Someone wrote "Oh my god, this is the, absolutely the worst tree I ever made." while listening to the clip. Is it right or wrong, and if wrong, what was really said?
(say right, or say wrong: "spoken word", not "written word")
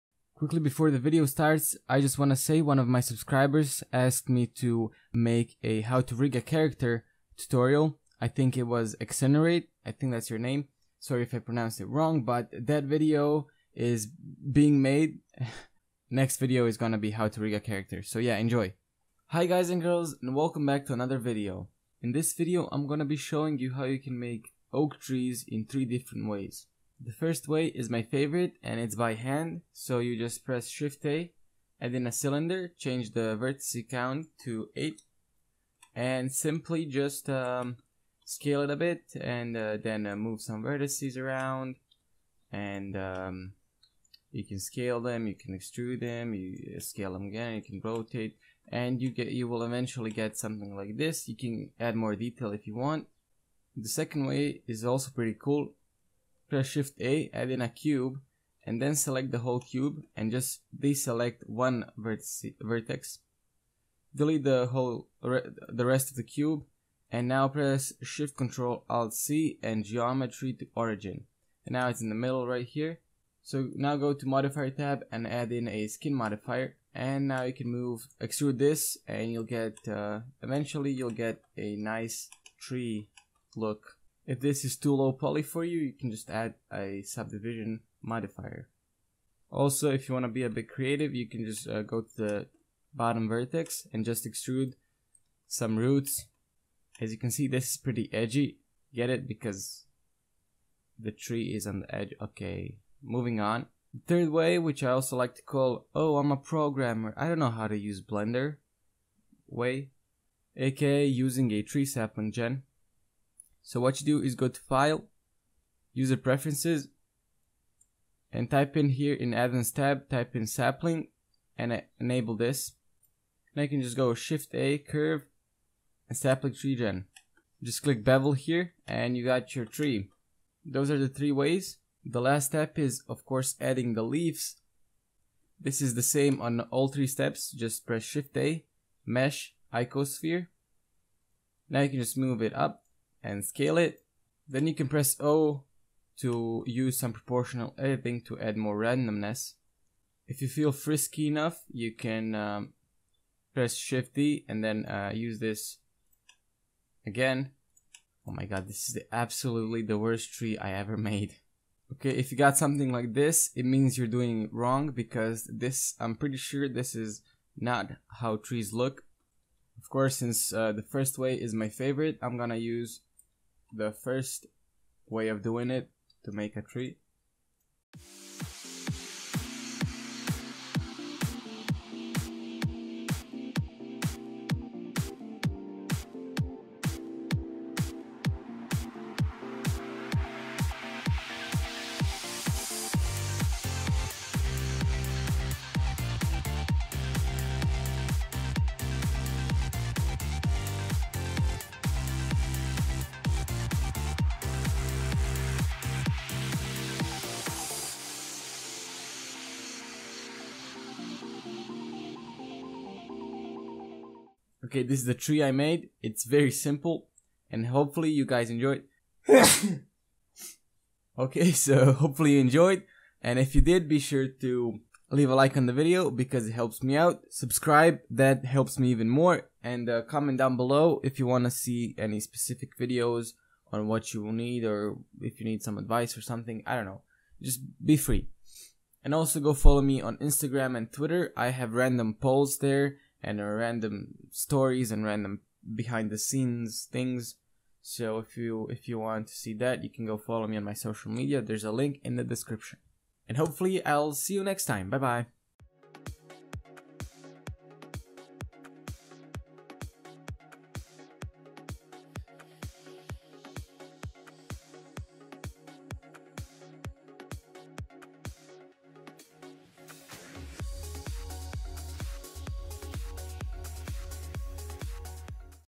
right.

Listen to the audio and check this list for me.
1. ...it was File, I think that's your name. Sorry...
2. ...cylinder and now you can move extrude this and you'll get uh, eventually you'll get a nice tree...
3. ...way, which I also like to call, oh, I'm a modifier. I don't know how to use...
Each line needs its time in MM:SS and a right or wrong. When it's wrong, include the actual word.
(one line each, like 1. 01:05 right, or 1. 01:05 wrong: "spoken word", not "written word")
1. 00:08 wrong: "Exonerate", not "File"
2. 01:16 wrong: "modifier", not "cylinder"
3. 01:44 wrong: "programmer", not "modifier".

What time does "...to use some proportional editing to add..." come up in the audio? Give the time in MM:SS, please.
02:26.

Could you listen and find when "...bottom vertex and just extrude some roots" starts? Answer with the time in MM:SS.
01:32.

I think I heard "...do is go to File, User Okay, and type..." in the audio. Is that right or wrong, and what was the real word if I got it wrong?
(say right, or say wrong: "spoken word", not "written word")
wrong: "Preferences", not "Okay".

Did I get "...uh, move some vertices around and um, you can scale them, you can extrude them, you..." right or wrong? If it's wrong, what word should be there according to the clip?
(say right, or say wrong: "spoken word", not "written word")
right.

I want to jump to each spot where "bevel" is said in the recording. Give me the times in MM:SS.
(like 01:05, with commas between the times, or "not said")
02:08.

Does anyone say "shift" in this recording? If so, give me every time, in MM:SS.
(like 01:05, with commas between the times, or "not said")
00:30, 00:56, 01:08, 02:04, 02:18, 02:33.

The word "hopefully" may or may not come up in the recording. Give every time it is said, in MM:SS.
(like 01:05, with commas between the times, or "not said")
03:37, 03:41, 04:13.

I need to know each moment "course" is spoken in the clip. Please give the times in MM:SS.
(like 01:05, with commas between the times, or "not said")
02:13, 02:49.